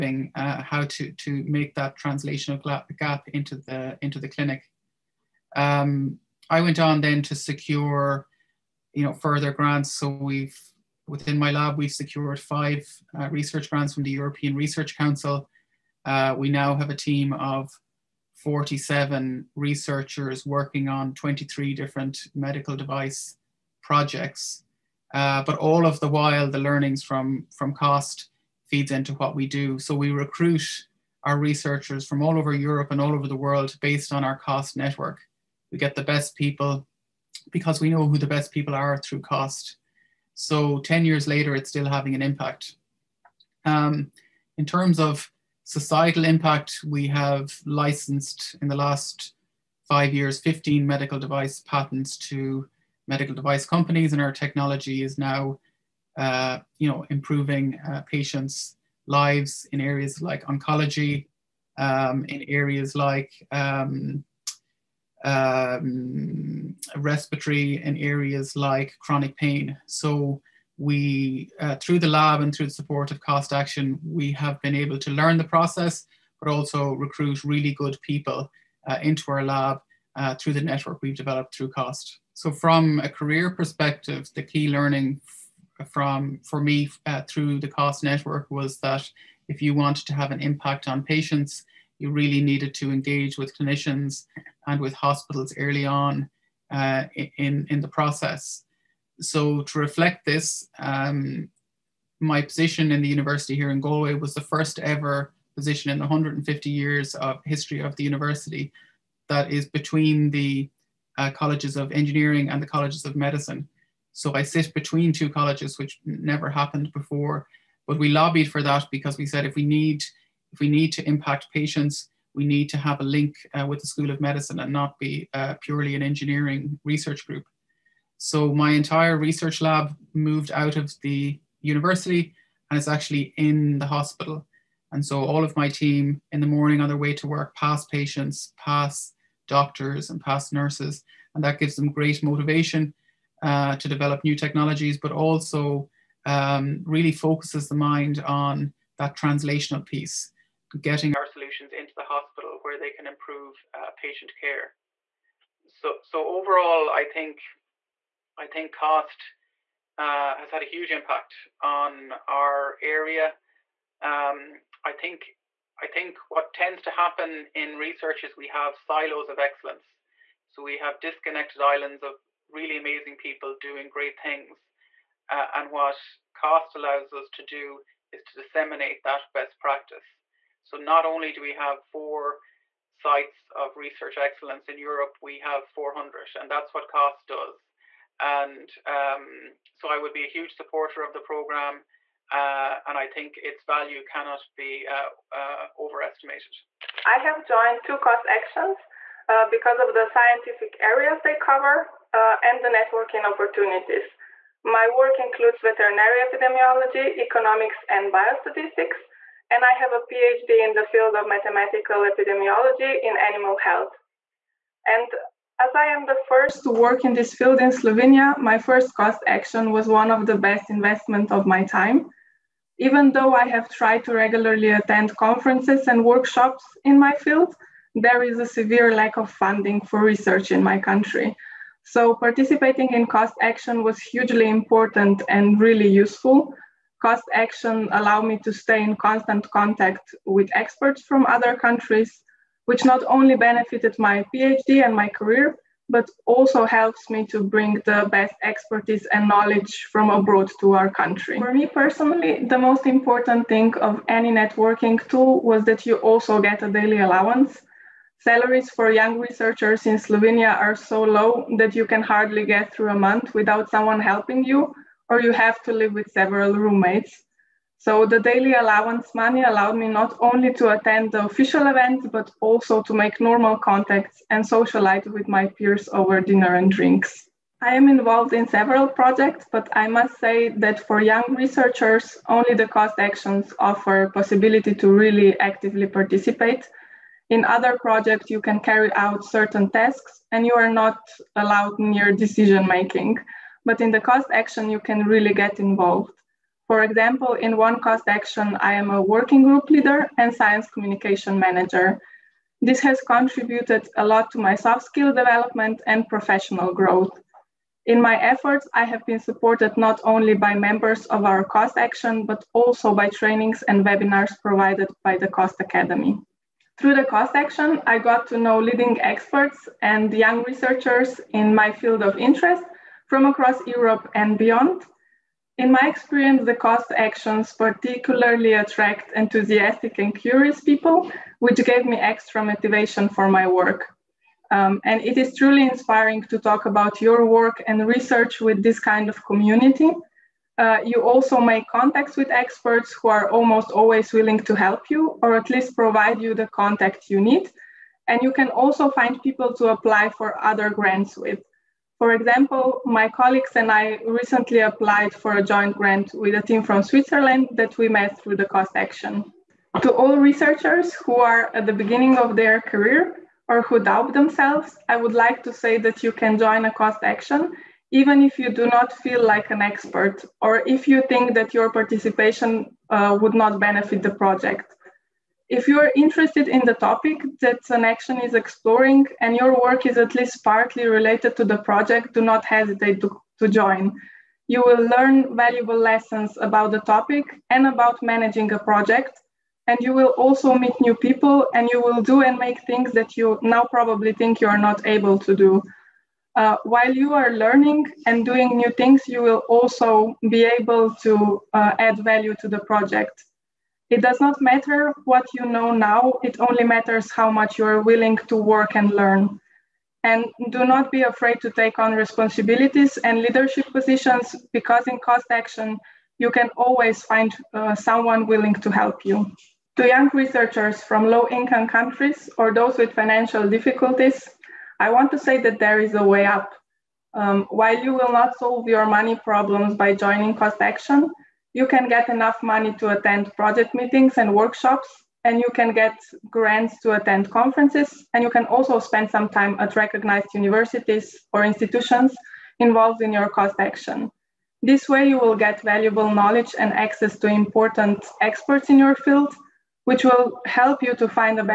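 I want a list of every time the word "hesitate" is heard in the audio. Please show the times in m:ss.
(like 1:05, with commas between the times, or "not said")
6:22.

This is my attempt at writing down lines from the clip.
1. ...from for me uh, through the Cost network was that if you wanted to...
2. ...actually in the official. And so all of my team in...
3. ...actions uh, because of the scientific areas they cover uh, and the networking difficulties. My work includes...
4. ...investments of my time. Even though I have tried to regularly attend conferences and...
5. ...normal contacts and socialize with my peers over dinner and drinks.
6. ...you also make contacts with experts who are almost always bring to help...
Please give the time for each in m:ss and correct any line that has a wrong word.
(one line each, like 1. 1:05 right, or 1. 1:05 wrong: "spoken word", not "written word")
1. 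1:25 right
2. 2:12 wrong: "hospital", not "official"
3. 3:18 wrong: "opportunities", not "difficulties"
4. 3:40 right
5. 4:33 right
6. 5:40 wrong: "willing", not "bring".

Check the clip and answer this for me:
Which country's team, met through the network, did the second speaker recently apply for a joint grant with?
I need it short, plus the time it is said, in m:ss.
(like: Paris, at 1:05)
Switzerland, at 5:56.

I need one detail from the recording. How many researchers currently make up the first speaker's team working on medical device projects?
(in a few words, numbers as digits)
47.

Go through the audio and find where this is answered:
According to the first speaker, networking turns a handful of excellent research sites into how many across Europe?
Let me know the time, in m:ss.
3:05.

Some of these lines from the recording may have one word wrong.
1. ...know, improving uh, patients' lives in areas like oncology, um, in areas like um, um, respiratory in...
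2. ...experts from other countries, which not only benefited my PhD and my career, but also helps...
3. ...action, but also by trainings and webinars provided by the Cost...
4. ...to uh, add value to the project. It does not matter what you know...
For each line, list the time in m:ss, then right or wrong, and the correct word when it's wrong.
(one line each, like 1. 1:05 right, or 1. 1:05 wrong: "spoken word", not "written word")
1. 0:56 right
2. 4:00 right
3. 5:11 right
4. 6:41 right.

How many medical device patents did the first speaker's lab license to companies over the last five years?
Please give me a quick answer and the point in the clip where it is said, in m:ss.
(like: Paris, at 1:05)
15, at 0:50.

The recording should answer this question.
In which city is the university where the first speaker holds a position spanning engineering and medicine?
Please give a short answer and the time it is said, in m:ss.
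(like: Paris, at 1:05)
Galway, at 1:43.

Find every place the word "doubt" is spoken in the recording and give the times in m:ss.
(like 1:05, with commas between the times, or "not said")
6:03.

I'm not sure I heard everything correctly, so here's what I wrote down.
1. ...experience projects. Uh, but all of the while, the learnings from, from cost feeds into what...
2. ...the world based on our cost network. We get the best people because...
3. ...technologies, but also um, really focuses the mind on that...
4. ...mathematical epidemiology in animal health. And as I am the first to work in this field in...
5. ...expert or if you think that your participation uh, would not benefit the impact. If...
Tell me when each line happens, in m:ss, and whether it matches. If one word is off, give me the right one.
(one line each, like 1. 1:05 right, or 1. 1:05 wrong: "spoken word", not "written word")
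1. 0:22 wrong: "device", not "experience"
2. 0:33 right
3. 2:24 right
4. 3:31 right
5. 6:09 wrong: "project", not "impact".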